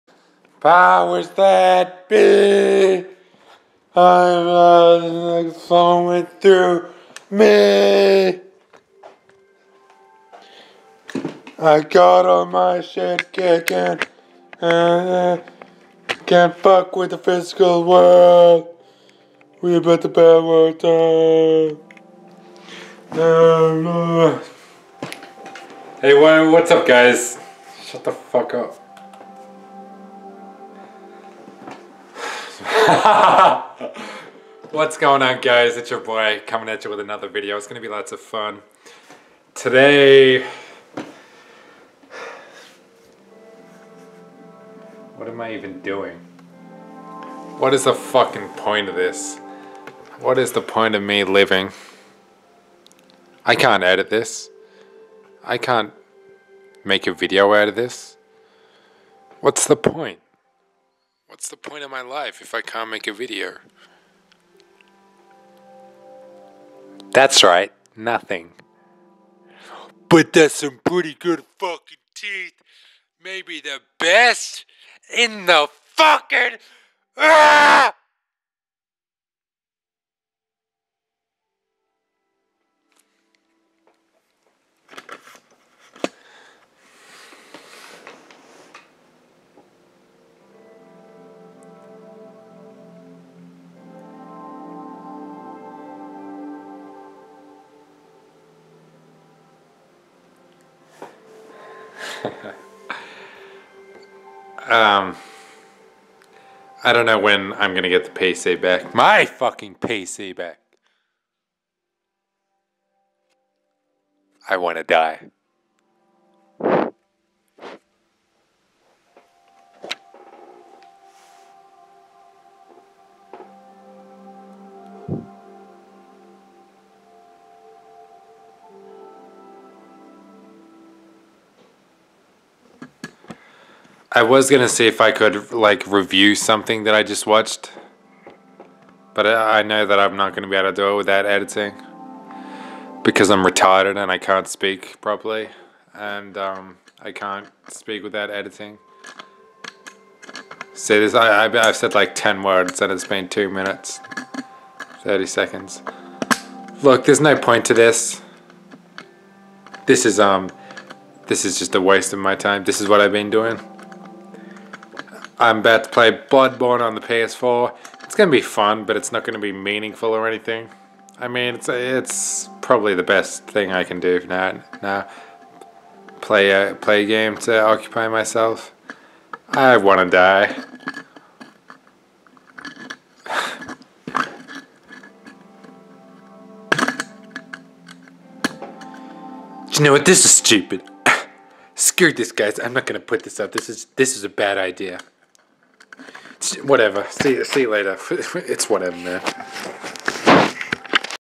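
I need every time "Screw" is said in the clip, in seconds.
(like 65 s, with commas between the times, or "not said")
191 s.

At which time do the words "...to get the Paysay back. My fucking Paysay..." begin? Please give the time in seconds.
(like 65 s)
107 s.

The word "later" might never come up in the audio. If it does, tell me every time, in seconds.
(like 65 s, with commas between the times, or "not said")
197 s.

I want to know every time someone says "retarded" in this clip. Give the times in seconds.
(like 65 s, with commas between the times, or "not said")
143 s.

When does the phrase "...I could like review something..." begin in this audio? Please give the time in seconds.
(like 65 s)
134 s.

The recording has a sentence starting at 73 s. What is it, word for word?
Maybe the best in the fucking.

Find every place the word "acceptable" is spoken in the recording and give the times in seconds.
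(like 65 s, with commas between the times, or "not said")
not said.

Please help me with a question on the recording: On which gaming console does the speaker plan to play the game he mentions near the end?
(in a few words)
PS4.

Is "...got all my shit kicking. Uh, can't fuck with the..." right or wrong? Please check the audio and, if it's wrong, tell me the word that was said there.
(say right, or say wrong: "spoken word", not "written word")
right.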